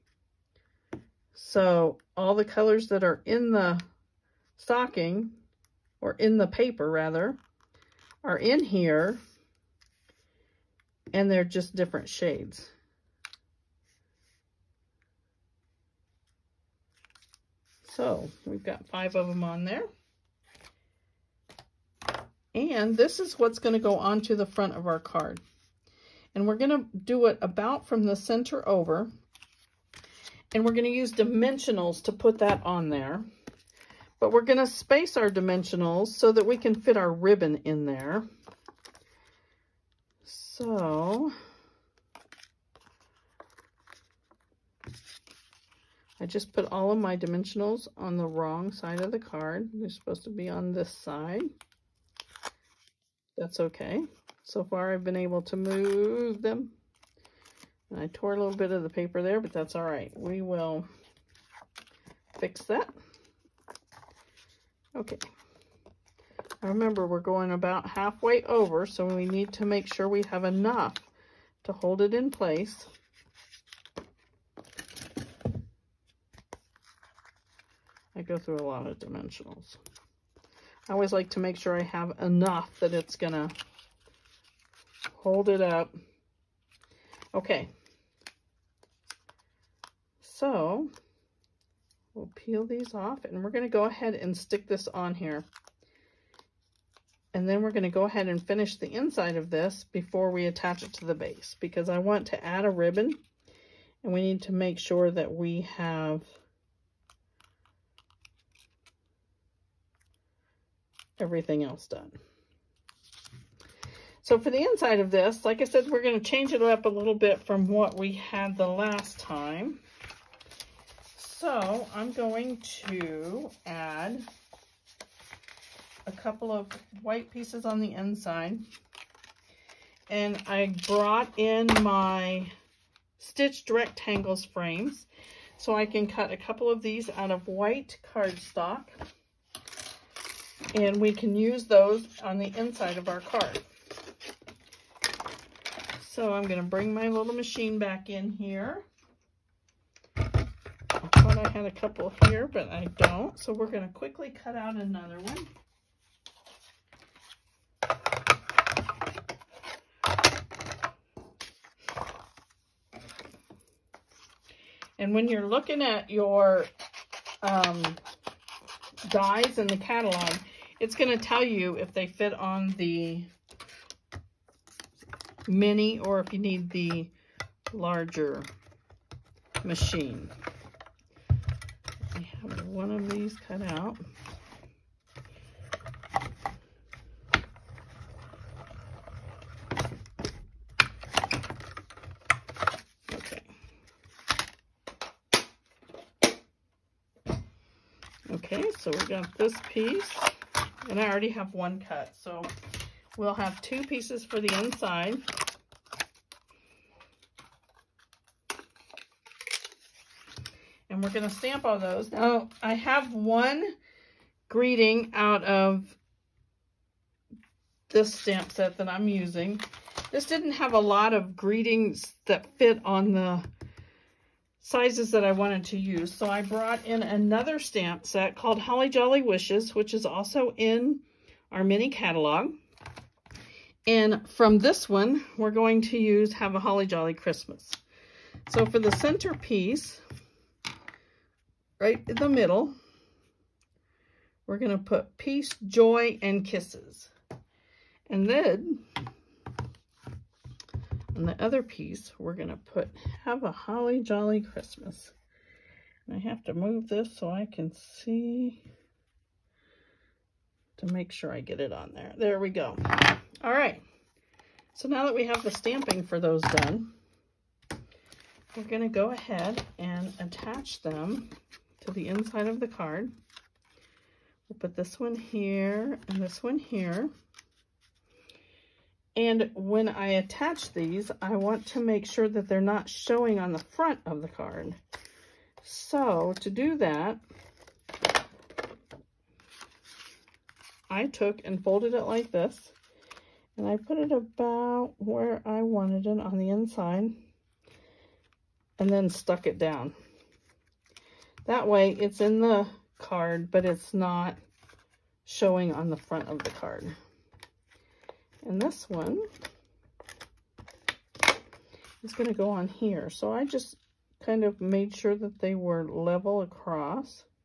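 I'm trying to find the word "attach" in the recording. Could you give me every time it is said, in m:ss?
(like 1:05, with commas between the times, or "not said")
1:40, 4:30, 4:40.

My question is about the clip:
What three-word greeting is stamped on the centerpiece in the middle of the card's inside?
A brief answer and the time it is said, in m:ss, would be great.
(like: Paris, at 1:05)
Peace, Joy, and Kisses, at 4:05.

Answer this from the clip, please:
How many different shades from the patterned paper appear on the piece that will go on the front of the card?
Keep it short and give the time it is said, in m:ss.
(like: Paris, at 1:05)
5, at 0:18.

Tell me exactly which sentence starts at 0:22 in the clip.
And this is what's going to go onto the front of our card.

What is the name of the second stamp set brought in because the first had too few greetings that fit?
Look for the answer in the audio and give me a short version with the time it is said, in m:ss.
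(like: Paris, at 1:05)
Holly Jolly Wishes, at 3:48.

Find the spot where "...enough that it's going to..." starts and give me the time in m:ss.
1:22.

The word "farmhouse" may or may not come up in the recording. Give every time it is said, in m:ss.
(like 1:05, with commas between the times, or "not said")
not said.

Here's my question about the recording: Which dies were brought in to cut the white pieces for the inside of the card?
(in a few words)
Stitched rectangles frames.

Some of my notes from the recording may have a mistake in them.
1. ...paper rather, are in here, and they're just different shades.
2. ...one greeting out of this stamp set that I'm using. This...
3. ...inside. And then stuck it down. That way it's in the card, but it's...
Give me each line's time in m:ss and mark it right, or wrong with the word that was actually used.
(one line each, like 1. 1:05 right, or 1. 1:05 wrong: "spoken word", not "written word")
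1. 0:06 right
2. 3:33 right
3. 4:56 right.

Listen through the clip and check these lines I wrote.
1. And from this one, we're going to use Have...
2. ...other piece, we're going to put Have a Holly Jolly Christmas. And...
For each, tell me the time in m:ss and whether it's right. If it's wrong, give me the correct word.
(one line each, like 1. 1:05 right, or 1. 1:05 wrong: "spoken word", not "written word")
1. 3:53 right
2. 4:11 right.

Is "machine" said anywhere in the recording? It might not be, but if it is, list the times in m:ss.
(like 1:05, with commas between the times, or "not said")
2:27, 2:59.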